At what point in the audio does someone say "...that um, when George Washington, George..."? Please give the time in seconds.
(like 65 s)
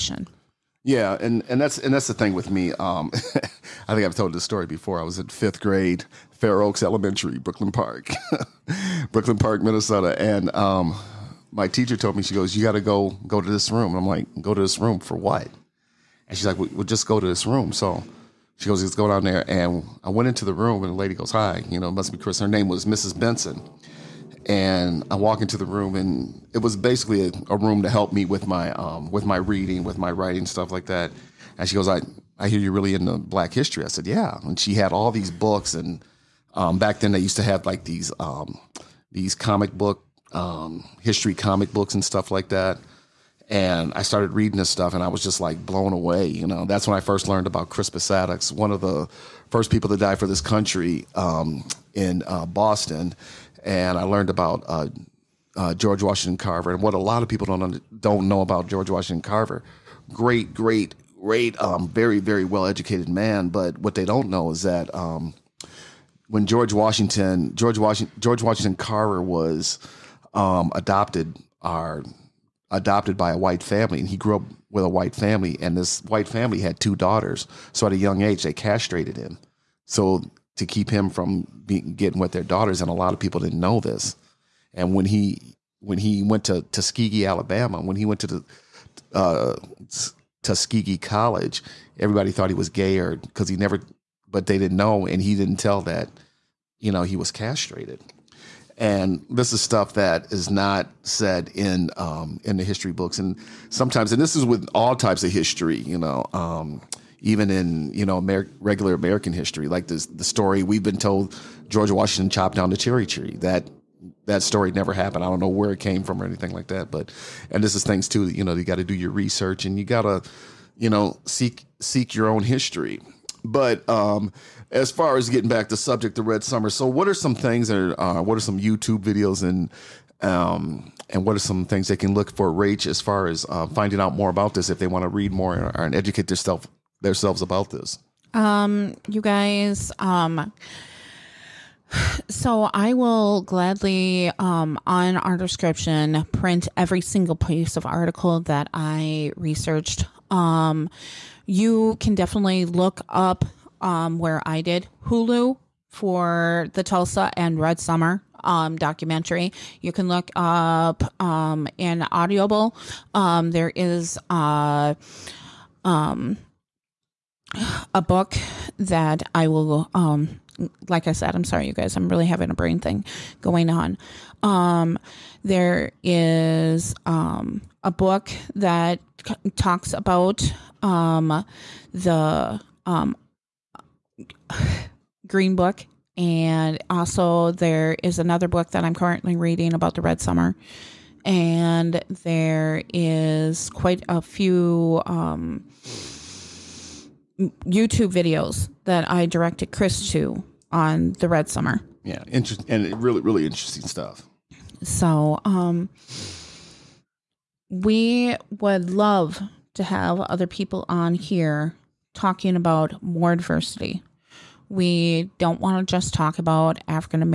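64 s.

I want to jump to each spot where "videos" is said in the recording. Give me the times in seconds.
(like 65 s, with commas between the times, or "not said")
128 s, 198 s.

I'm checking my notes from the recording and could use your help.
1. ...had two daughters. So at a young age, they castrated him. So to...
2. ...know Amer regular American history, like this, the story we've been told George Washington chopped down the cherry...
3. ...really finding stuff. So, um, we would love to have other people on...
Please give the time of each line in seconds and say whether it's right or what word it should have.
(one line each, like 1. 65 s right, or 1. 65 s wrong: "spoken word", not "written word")
1. 76 s right
2. 108 s right
3. 203 s wrong: "interesting", not "finding".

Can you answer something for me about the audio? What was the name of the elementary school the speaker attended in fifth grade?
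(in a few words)
Fair Oaks Elementary.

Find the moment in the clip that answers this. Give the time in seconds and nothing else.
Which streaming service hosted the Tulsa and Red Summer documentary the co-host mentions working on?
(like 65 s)
155 s.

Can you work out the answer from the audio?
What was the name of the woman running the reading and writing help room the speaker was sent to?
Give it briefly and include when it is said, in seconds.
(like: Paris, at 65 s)
Mrs. Benson, at 22 s.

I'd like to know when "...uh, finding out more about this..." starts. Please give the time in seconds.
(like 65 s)
133 s.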